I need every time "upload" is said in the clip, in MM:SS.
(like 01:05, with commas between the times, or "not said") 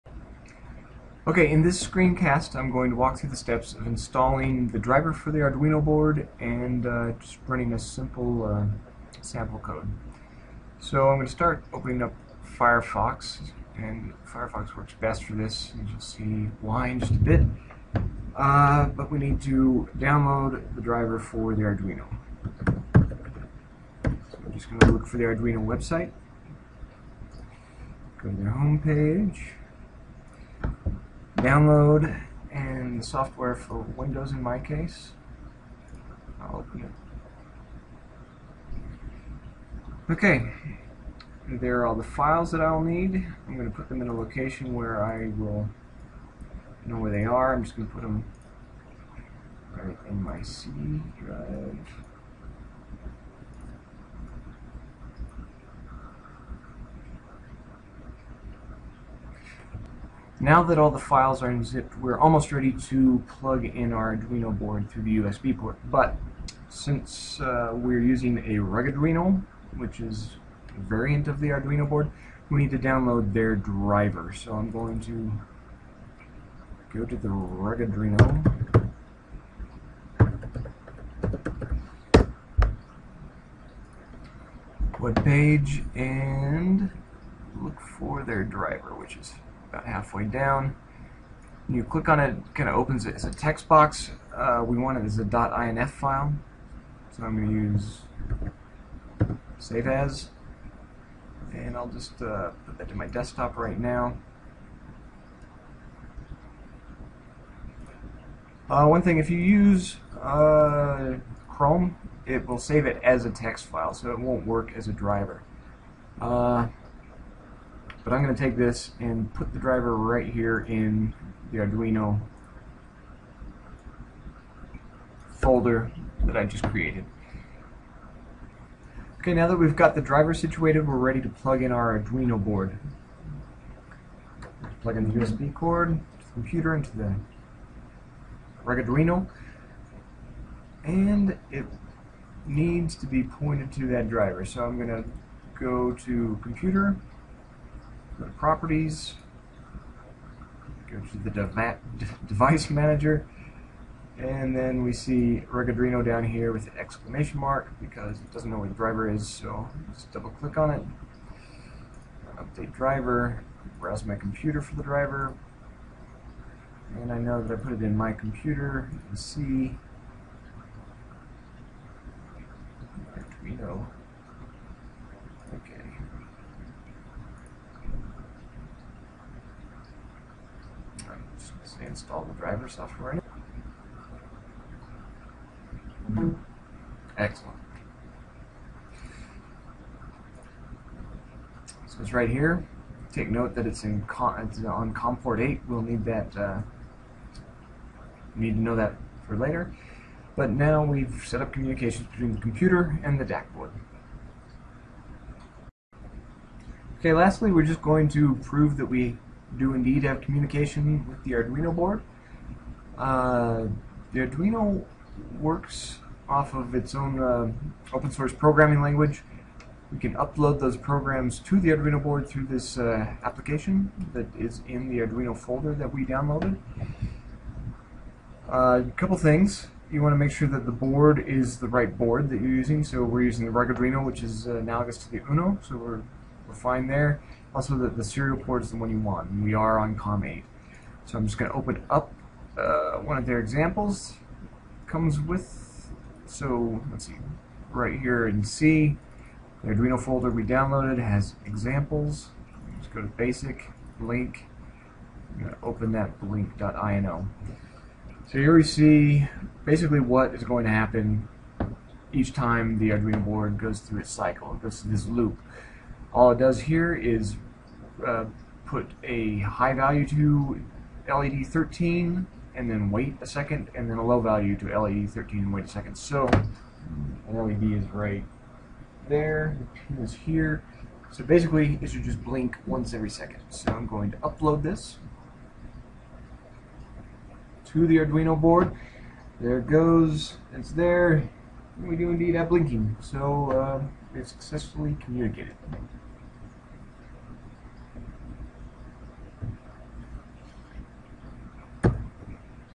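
03:40, 04:44.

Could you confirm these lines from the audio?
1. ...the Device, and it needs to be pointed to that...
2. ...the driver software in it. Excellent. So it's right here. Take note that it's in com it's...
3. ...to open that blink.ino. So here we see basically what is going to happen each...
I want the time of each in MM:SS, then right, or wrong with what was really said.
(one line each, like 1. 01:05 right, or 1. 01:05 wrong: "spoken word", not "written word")
1. 02:16 wrong: "Arduino", not "Device"
2. 03:02 right
3. 04:15 right.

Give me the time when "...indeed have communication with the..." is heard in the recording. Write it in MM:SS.
03:29.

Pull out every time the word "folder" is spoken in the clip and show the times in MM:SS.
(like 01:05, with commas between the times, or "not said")
02:05, 03:45, 04:09.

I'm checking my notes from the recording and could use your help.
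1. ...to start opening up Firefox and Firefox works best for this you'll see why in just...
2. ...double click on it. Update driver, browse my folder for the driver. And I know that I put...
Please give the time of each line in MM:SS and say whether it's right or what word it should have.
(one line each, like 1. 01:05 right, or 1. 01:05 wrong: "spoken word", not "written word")
1. 00:11 right
2. 02:40 wrong: "computer", not "folder".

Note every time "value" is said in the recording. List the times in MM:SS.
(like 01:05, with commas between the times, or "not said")
04:29, 04:34.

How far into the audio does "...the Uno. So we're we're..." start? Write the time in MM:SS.
03:55.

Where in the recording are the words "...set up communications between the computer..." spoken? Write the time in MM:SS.
03:21.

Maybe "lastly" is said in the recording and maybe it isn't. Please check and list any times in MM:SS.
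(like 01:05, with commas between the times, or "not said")
03:27.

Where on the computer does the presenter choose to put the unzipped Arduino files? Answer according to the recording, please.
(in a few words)
C drive.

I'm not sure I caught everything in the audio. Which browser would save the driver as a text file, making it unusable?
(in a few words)
Chrome.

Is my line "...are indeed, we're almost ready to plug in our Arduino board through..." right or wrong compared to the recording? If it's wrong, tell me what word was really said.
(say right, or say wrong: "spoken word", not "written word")
wrong: "unzipped", not "indeed".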